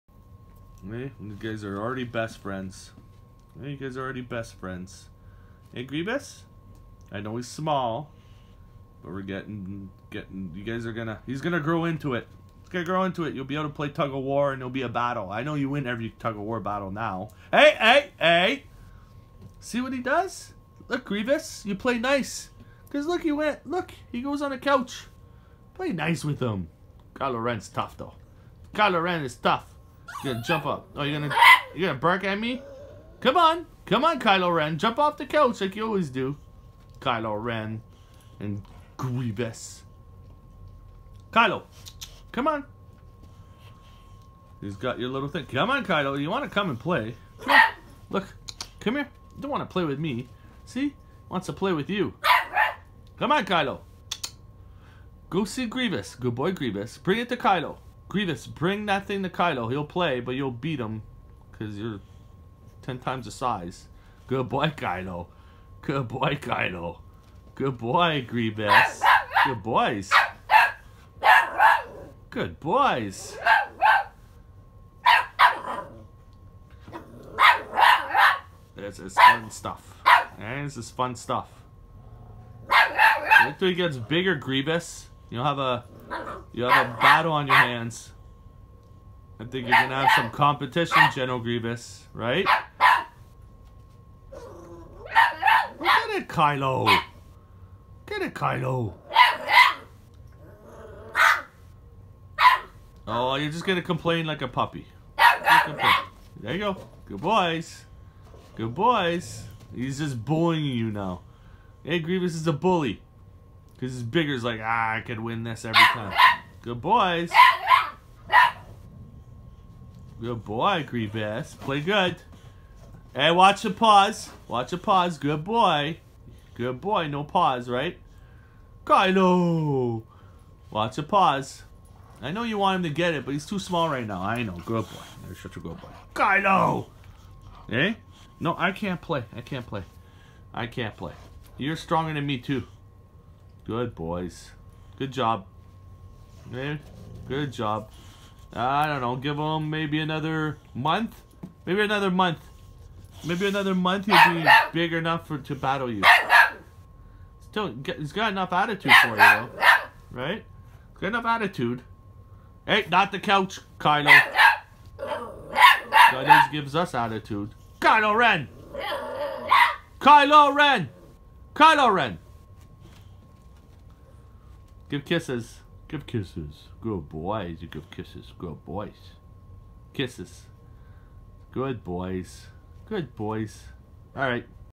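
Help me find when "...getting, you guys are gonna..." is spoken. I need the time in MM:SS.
00:10.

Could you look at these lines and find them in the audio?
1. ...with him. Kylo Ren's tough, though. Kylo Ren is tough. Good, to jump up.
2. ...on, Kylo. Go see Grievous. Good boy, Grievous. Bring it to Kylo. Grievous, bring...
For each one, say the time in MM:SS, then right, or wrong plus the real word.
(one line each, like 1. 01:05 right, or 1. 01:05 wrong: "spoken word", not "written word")
1. 00:26 right
2. 00:53 right.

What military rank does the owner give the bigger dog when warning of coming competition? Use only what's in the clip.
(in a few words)
General.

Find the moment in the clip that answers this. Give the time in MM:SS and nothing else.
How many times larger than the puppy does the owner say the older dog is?
01:02.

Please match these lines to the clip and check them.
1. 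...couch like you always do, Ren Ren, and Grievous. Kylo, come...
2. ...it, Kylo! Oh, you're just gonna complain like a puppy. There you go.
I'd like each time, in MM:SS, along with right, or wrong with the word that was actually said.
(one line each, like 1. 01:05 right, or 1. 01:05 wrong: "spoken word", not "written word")
1. 00:35 wrong: "Kylo", not "Ren"
2. 01:38 right.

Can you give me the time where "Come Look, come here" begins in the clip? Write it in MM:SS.
00:47.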